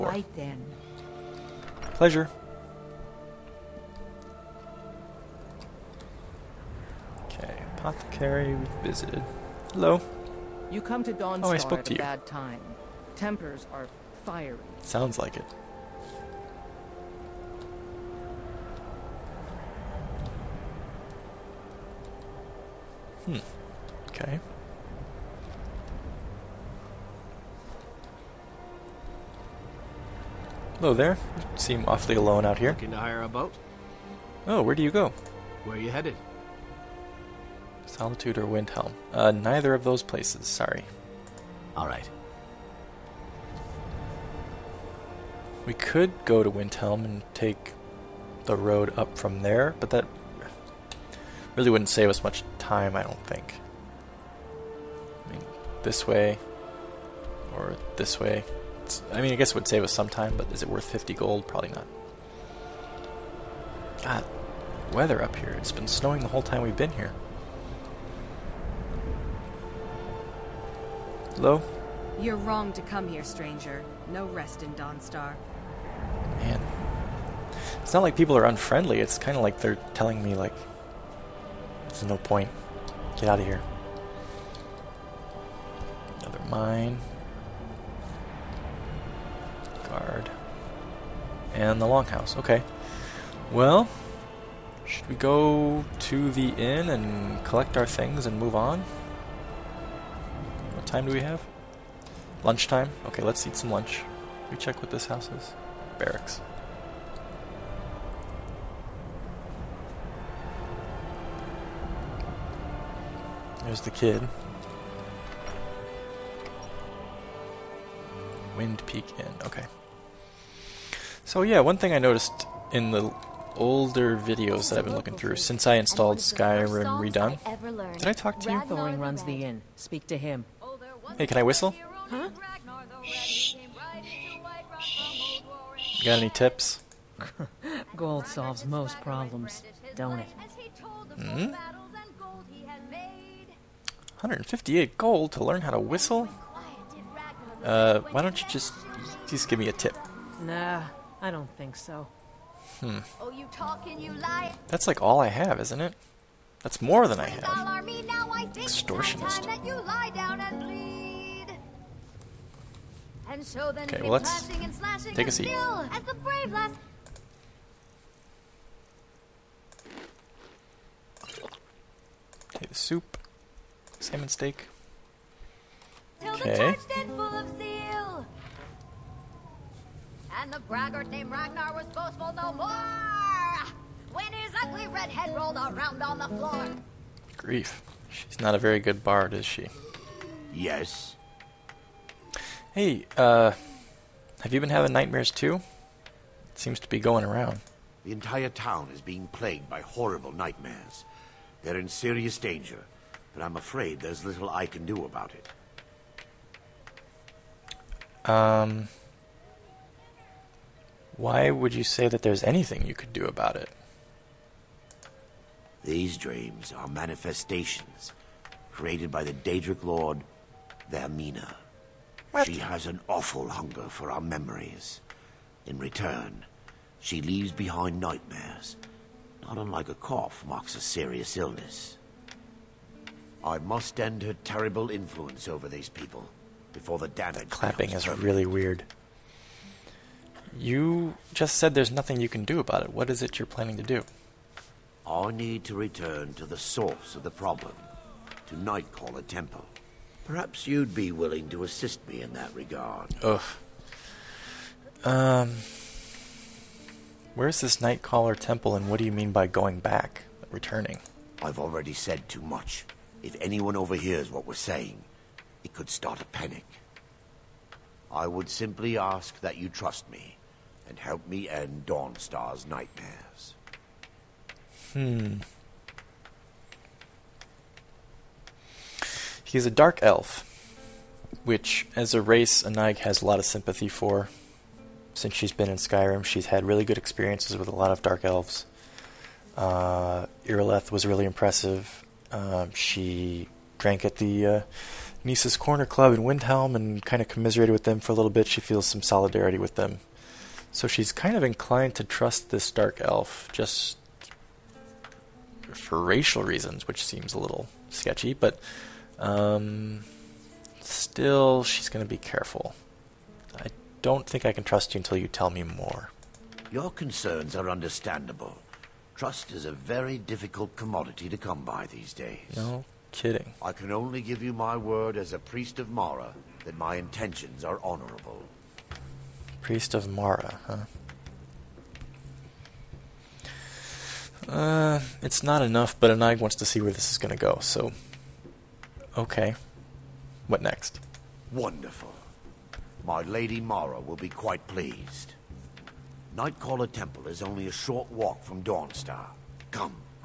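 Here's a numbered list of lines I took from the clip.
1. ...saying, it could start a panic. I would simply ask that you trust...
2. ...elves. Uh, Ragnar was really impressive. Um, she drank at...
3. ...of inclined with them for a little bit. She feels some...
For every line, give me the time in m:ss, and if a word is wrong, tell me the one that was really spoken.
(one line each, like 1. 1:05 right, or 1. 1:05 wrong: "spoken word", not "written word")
1. 4:24 right
2. 4:48 wrong: "Irileth", not "Ragnar"
3. 4:57 wrong: "commiserated", not "inclined".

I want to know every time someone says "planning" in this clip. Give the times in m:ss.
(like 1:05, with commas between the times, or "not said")
4:03.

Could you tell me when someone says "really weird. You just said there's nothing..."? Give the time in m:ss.
3:58.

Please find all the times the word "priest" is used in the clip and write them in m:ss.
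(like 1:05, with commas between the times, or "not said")
5:25, 5:29.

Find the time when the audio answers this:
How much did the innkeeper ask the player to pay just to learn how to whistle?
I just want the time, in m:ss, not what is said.
2:24.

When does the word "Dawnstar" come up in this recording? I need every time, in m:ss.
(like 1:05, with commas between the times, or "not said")
0:11, 1:14, 4:31, 5:48.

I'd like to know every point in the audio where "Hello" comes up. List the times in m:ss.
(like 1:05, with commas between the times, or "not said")
0:09, 0:30, 1:11.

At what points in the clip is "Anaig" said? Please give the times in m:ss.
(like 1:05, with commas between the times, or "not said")
4:42, 5:36.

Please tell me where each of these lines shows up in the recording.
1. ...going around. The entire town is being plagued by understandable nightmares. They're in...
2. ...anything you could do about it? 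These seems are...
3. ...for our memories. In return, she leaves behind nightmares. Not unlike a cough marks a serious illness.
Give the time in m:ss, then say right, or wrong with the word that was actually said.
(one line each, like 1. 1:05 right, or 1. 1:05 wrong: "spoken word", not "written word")
1. 3:16 wrong: "horrible", not "understandable"
2. 3:32 wrong: "dreams", not "seems"
3. 3:43 right.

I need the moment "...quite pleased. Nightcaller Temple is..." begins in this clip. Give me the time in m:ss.
5:44.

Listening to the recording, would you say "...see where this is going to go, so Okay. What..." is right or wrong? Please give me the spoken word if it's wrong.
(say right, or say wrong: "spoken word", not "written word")
right.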